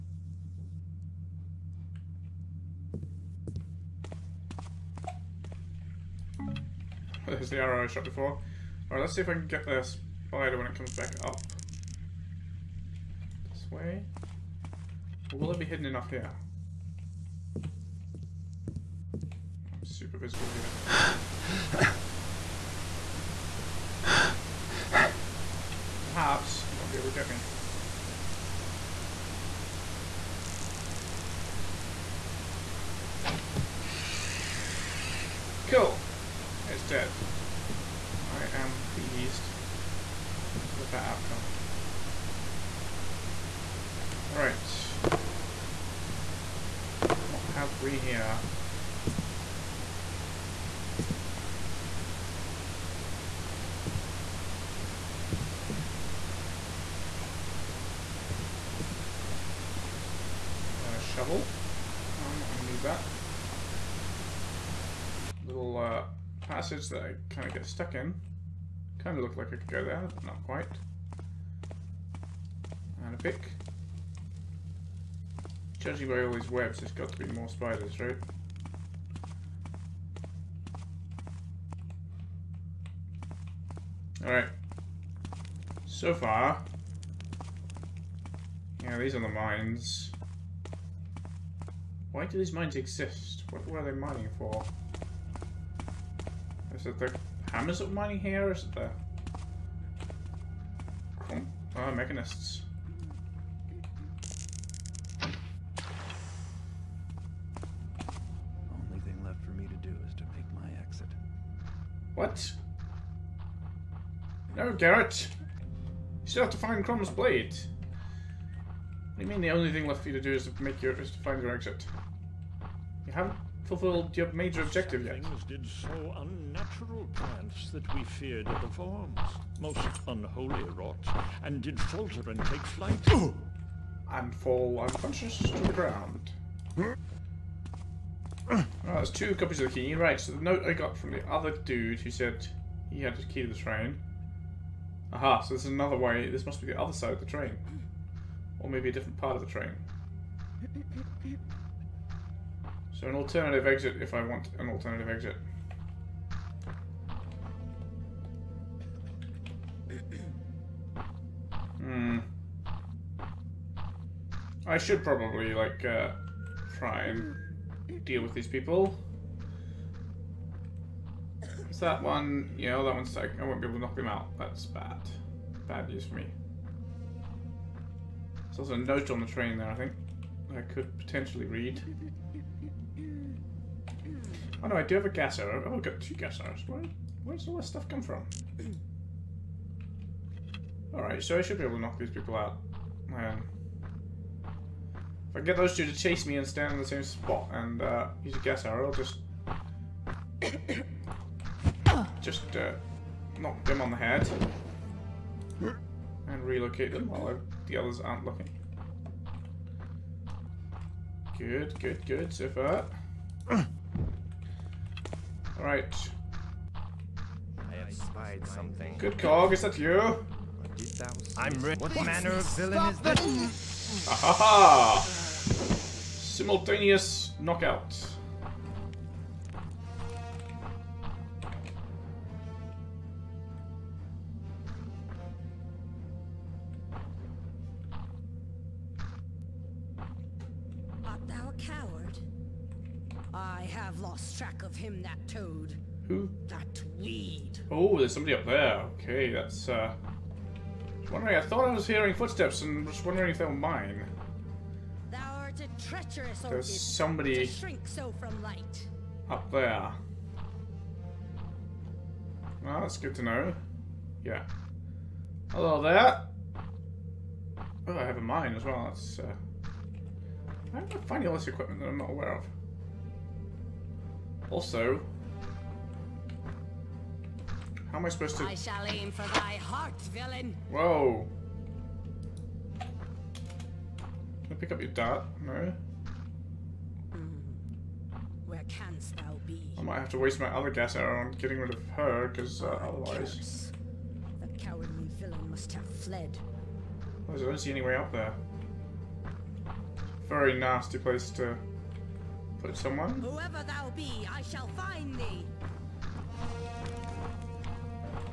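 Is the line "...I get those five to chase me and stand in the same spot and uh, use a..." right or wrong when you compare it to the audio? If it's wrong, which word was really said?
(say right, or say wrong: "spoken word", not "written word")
wrong: "two", not "five".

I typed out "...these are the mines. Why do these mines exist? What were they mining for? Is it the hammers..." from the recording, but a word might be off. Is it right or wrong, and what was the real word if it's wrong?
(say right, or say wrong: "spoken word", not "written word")
right.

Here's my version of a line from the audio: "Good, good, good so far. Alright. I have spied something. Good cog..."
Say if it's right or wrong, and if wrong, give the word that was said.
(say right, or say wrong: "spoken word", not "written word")
right.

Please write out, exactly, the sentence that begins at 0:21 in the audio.
but perhaps it won't be able to get me.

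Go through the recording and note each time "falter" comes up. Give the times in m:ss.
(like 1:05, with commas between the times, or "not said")
2:11.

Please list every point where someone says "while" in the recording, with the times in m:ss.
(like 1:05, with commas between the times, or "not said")
3:27.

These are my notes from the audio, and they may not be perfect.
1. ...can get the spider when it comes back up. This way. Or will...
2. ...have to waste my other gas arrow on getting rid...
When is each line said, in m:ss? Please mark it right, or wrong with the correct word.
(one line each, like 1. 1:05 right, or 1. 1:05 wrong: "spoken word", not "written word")
1. 0:09 right
2. 4:49 right.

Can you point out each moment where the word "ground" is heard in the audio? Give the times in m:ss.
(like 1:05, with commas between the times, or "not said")
2:15.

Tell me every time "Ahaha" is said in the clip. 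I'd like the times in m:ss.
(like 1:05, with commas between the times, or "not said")
3:44.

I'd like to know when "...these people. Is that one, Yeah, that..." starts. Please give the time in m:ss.
2:48.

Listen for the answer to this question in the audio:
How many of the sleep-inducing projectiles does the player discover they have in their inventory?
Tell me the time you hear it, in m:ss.
3:06.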